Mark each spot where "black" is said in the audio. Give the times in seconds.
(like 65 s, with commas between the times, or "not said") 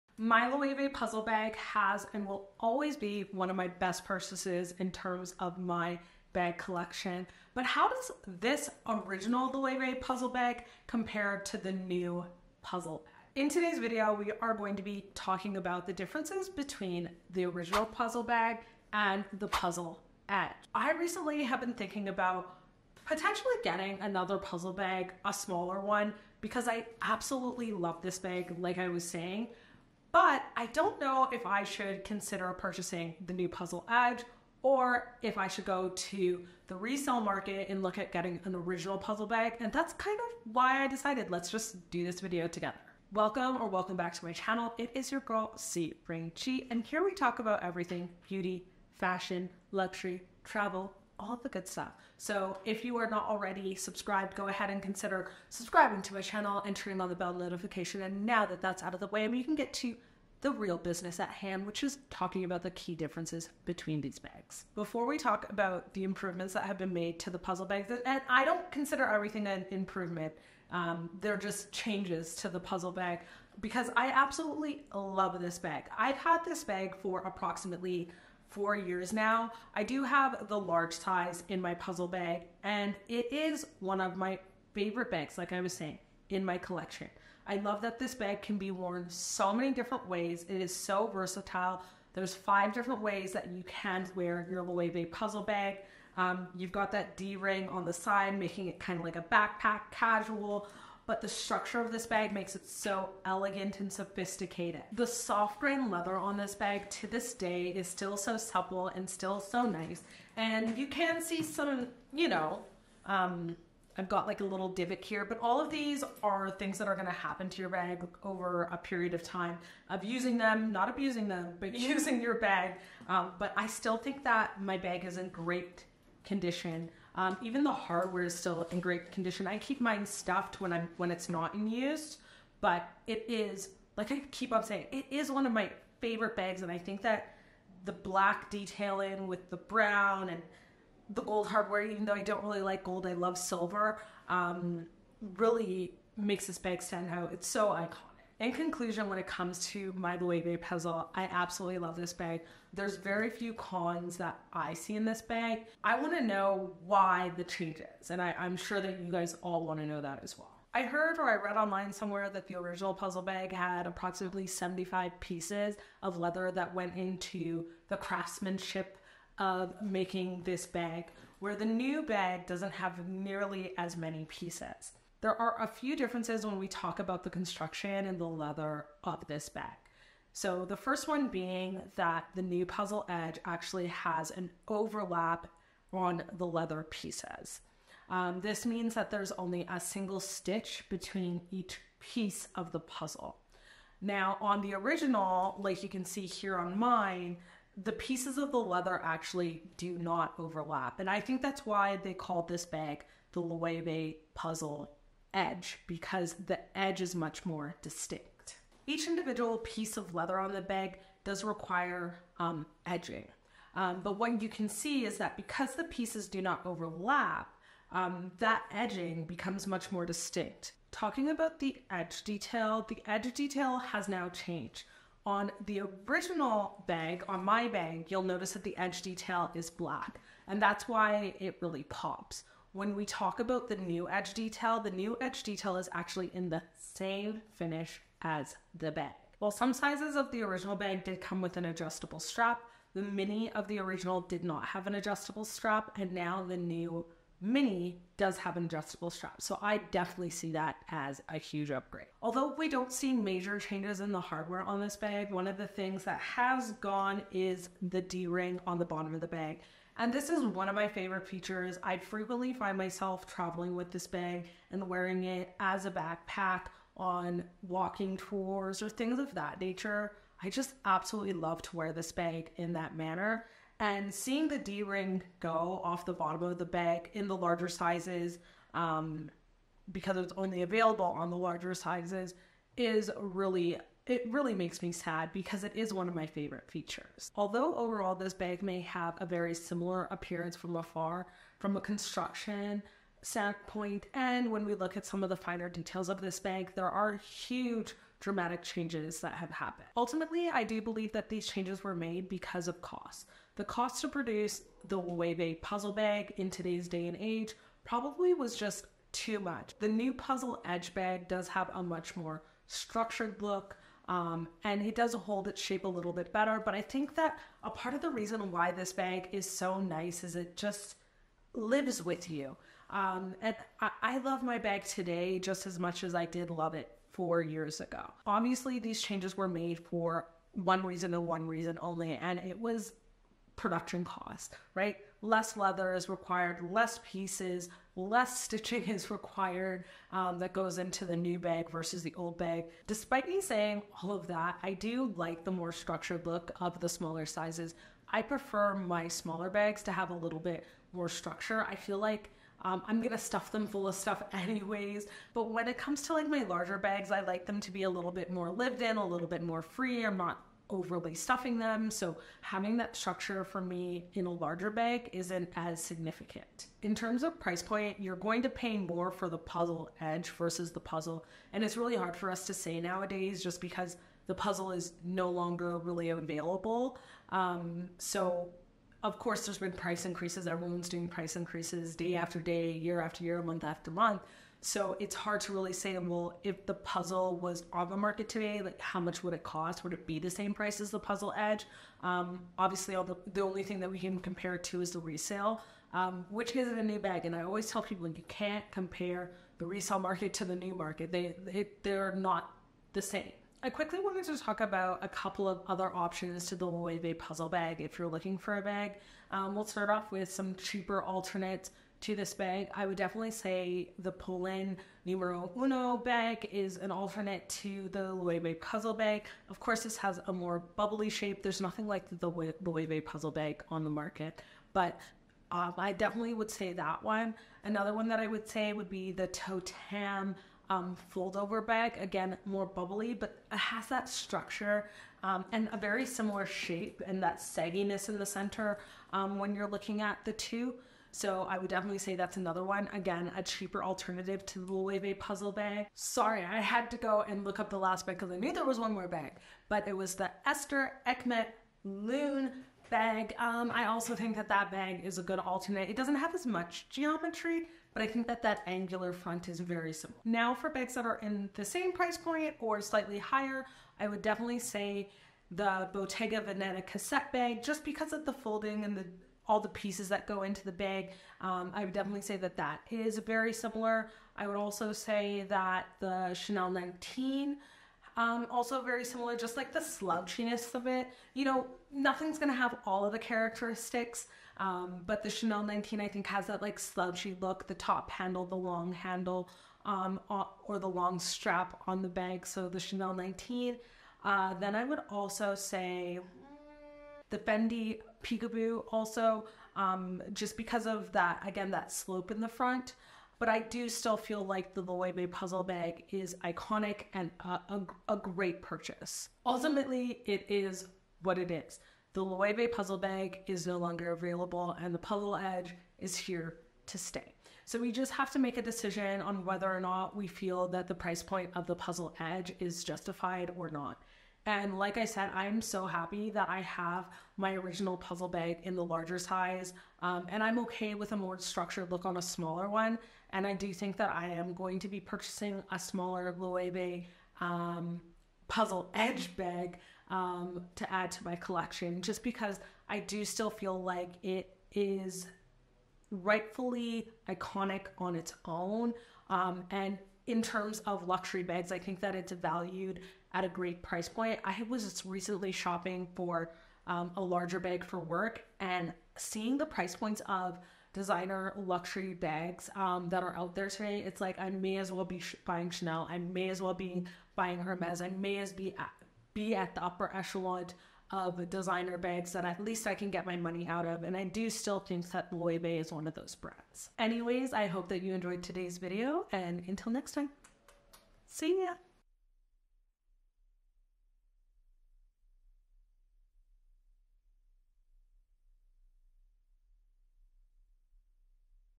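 137 s, 229 s.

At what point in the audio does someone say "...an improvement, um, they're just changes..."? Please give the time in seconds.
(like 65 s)
69 s.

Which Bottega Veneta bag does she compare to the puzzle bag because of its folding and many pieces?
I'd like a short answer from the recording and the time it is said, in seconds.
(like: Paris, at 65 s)
Cassette, at 465 s.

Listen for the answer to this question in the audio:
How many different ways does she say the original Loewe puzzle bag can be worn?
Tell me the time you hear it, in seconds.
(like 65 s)
92 s.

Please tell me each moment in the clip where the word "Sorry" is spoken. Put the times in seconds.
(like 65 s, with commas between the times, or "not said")
445 s.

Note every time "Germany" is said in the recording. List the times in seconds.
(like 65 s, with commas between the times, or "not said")
not said.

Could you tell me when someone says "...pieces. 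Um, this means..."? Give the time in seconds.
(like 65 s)
186 s.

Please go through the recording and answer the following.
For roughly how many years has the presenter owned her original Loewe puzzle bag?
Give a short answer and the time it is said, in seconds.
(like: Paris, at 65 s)
4, at 77 s.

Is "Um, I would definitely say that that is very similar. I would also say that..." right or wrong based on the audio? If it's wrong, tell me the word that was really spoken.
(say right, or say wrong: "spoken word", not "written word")
right.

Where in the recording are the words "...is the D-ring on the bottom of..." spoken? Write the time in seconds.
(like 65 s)
257 s.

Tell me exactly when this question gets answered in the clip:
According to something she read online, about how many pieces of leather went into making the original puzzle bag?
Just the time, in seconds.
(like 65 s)
163 s.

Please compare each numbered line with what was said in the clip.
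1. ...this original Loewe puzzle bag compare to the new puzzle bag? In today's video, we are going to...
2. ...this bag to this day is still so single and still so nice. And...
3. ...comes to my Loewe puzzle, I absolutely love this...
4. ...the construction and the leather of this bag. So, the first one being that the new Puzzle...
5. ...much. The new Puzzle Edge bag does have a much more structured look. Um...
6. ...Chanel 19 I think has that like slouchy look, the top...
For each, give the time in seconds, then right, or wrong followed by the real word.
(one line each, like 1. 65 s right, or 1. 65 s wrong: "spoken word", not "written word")
1. 8 s right
2. 106 s wrong: "supple", not "single"
3. 149 s right
4. 177 s right
5. 309 s right
6. 485 s right.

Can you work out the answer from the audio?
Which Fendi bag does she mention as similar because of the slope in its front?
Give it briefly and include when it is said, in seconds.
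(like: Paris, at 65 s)
Peekaboo, at 497 s.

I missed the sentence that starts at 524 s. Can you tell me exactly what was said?
And like I said, I'm so happy that I have my original puzzle bag in the larger size.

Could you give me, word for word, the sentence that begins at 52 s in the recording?
So if you are not already subscribed, go ahead and consider subscribing to my channel and turning on the bell notification.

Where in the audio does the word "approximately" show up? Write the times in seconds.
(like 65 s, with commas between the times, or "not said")
77 s, 163 s.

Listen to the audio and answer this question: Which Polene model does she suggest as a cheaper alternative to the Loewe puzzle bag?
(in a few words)
Numero Uno.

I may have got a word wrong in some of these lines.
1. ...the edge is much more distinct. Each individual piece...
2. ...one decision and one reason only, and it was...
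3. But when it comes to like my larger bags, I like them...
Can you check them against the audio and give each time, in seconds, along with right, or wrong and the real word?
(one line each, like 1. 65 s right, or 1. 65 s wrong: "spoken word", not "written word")
1. 206 s right
2. 330 s wrong: "reason", not "decision"
3. 355 s right.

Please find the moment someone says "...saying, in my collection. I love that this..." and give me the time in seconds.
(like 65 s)
85 s.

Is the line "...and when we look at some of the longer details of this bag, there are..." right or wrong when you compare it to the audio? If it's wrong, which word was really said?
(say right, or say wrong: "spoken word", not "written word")
wrong: "finer", not "longer".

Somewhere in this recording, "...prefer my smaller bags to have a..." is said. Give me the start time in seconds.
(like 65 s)
348 s.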